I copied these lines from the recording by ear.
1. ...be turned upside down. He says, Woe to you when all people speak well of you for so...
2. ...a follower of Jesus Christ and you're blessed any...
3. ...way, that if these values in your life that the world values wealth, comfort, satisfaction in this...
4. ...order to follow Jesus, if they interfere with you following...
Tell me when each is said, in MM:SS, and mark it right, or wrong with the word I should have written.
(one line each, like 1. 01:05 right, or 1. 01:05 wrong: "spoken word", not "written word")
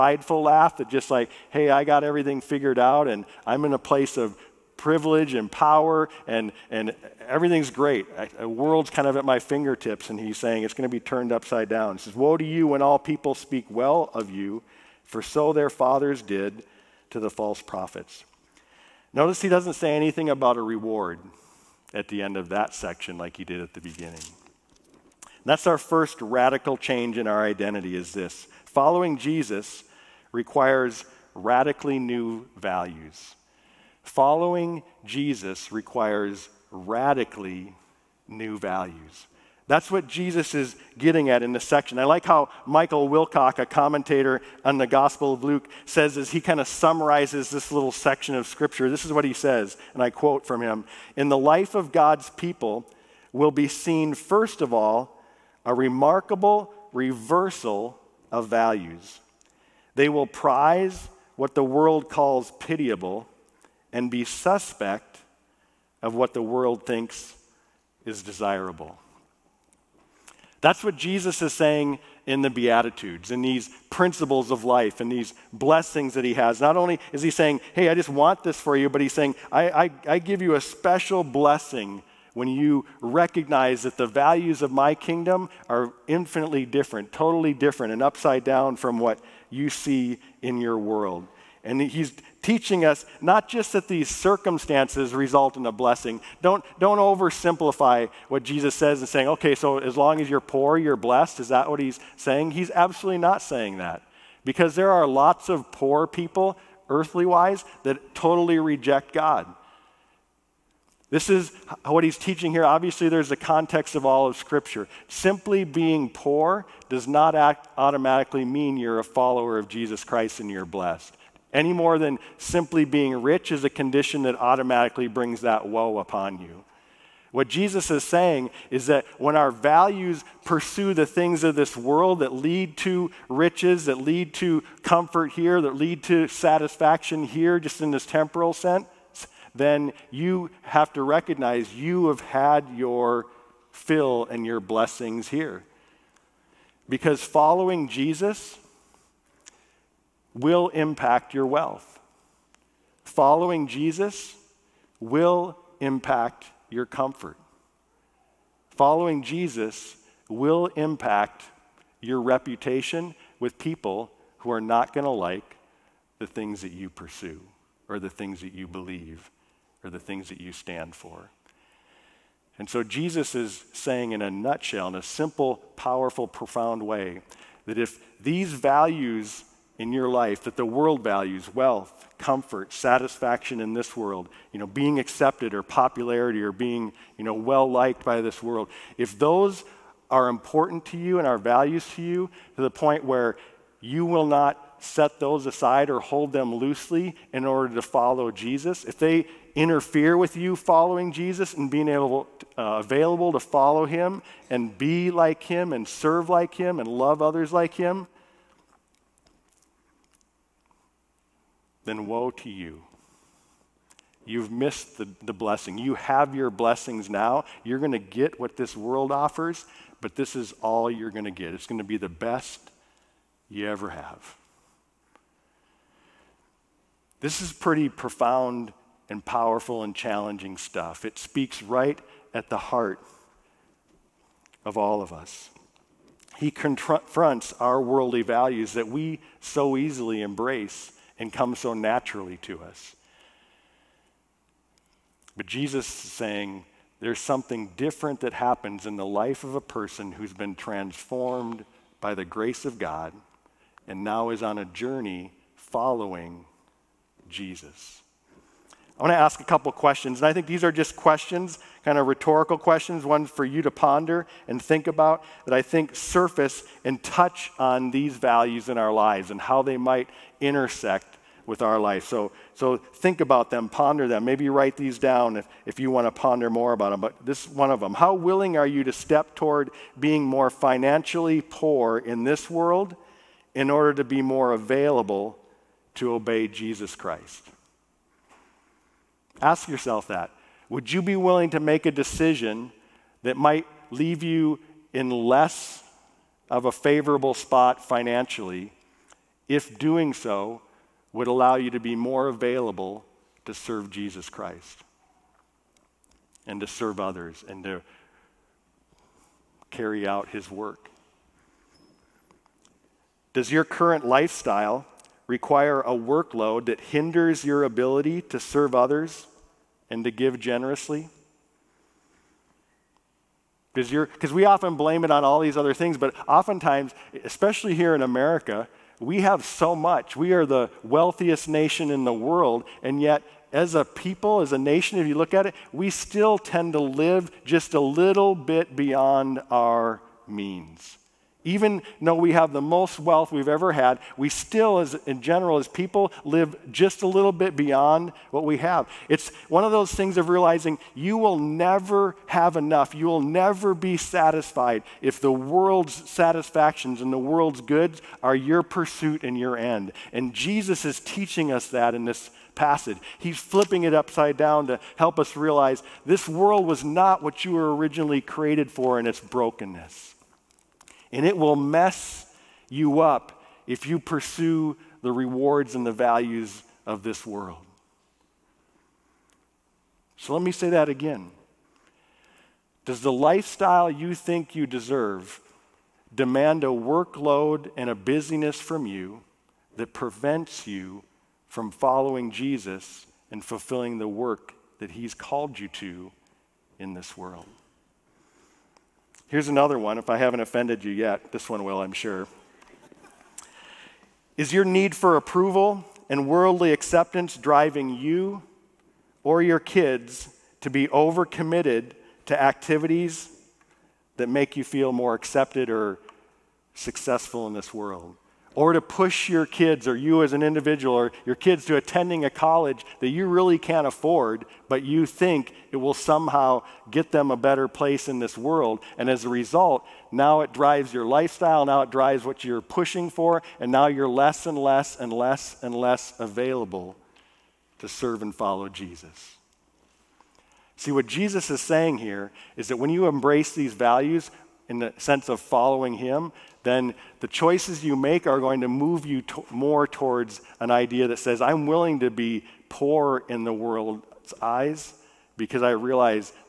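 1. 00:10 right
2. 01:58 right
3. 02:56 right
4. 03:17 right.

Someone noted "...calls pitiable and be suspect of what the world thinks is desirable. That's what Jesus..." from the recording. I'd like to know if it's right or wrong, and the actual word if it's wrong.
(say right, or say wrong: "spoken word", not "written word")
right.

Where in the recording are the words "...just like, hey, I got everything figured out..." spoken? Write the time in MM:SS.
00:00.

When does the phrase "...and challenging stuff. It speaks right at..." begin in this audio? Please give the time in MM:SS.
03:49.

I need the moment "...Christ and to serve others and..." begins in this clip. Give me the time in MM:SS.
05:04.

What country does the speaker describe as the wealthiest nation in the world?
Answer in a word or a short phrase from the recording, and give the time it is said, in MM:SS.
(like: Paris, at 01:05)
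America, at 05:28.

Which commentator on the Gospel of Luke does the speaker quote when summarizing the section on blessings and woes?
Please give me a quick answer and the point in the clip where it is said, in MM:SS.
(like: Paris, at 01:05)
Michael Wilcock, at 00:42.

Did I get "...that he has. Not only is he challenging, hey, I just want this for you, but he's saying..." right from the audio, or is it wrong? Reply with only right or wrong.
wrong.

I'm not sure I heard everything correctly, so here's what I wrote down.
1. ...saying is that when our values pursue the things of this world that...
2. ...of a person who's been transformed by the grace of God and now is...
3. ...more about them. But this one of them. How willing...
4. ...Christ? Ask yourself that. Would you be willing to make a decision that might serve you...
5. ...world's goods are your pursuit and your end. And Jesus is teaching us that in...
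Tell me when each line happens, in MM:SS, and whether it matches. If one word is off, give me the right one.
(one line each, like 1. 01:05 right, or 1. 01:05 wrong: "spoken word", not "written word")
1. 02:08 right
2. 04:09 right
3. 04:36 right
4. 04:46 wrong: "leave", not "serve"
5. 05:57 right.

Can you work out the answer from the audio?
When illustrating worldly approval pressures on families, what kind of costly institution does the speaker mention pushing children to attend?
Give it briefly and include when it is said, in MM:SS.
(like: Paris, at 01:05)
a college, at 07:02.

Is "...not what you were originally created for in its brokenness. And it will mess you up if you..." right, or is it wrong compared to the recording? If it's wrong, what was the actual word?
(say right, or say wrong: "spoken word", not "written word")
right.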